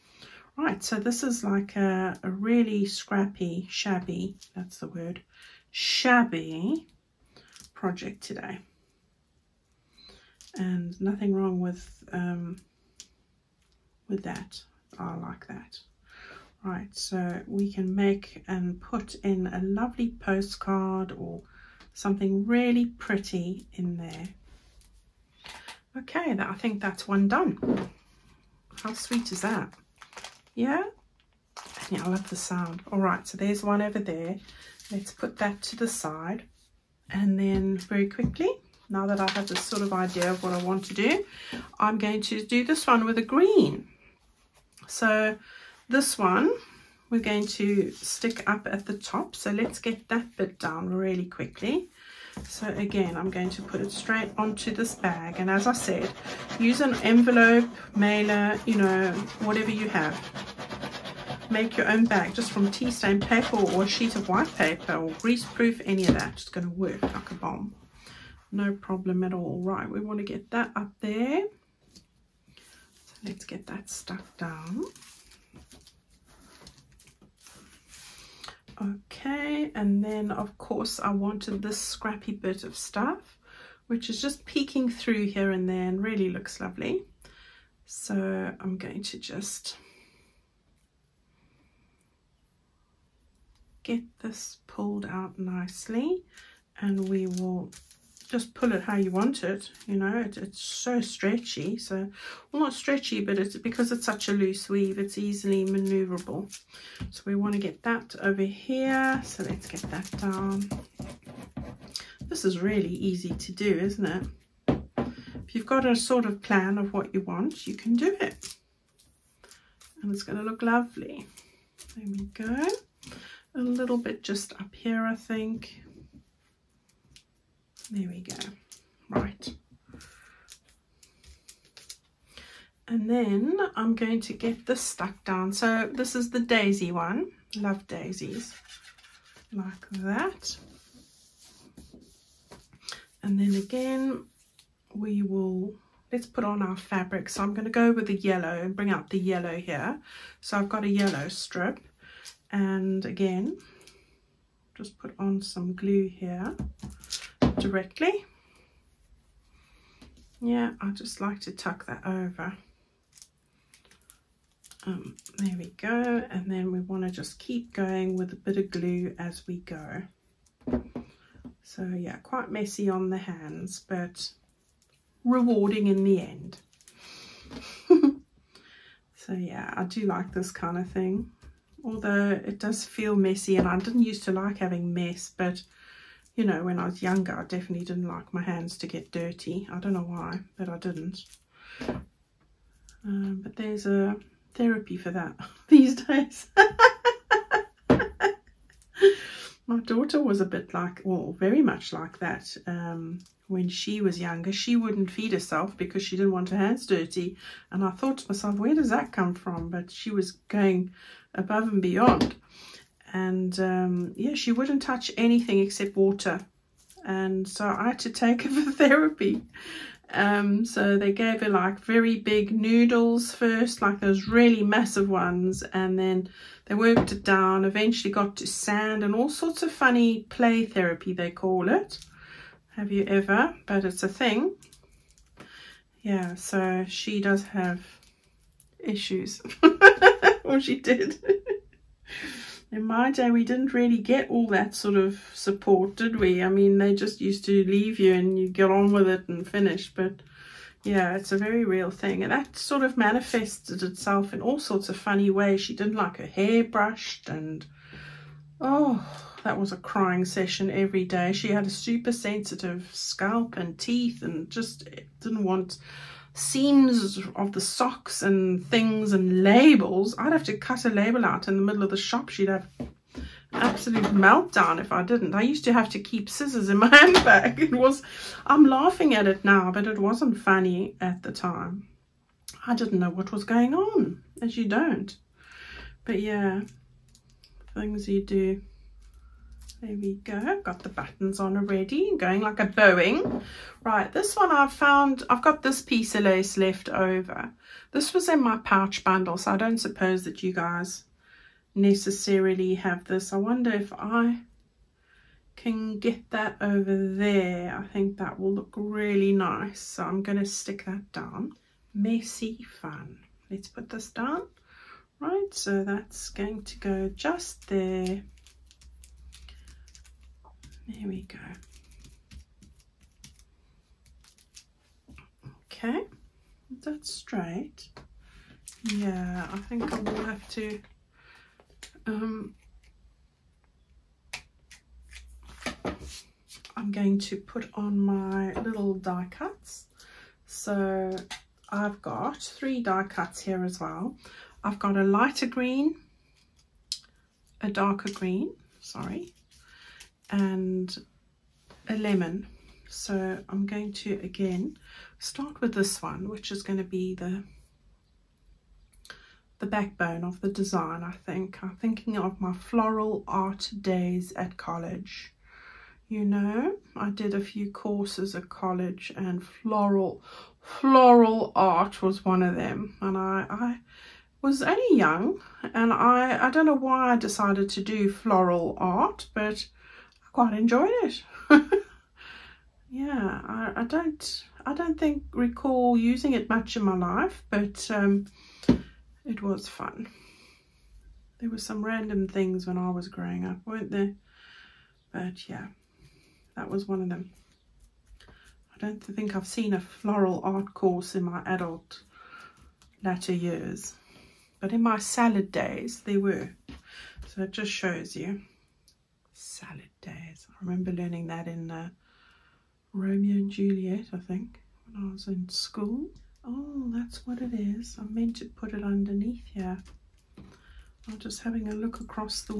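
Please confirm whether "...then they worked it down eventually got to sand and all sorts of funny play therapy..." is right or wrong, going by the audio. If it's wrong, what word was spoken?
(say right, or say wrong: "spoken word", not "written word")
right.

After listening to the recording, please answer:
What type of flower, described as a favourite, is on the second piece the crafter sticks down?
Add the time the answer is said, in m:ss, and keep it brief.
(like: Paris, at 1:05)
daisy, at 2:16.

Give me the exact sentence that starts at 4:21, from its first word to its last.
She had a super sensitive scalp and teeth and just didn't want seams of the socks and things and labels.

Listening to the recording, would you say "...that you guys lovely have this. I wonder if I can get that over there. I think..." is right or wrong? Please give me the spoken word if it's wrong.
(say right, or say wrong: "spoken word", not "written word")
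wrong: "necessarily", not "lovely".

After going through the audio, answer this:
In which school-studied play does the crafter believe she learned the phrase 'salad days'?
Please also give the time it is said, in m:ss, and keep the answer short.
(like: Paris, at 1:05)
Romeo and Juliet, at 6:52.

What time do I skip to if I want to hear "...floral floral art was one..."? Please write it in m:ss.
6:09.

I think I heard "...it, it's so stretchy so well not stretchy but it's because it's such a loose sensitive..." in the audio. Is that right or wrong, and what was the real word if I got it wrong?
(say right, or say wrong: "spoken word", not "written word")
wrong: "weave", not "sensitive".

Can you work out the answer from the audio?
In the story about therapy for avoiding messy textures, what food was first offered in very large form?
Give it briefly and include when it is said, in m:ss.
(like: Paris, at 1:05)
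noodles, at 3:42.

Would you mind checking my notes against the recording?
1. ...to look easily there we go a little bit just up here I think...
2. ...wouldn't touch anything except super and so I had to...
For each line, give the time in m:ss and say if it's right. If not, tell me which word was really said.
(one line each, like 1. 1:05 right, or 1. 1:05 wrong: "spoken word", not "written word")
1. 2:00 wrong: "lovely", not "easily"
2. 3:34 wrong: "water", not "super".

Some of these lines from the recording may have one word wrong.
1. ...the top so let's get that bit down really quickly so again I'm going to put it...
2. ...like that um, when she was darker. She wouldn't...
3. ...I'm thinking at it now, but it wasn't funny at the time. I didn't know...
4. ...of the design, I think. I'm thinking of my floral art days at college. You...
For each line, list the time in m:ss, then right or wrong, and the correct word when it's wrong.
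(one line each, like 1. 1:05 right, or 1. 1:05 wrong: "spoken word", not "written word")
1. 0:48 right
2. 3:21 wrong: "younger", not "darker"
3. 4:38 wrong: "laughing", not "thinking"
4. 6:00 right.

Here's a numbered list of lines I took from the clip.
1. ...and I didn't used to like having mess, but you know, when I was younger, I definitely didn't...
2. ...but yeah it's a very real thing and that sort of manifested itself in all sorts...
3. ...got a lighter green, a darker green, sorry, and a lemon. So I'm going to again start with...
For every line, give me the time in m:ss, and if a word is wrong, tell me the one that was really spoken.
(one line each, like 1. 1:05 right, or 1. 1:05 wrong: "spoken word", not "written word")
1. 3:03 right
2. 4:09 right
3. 5:44 right.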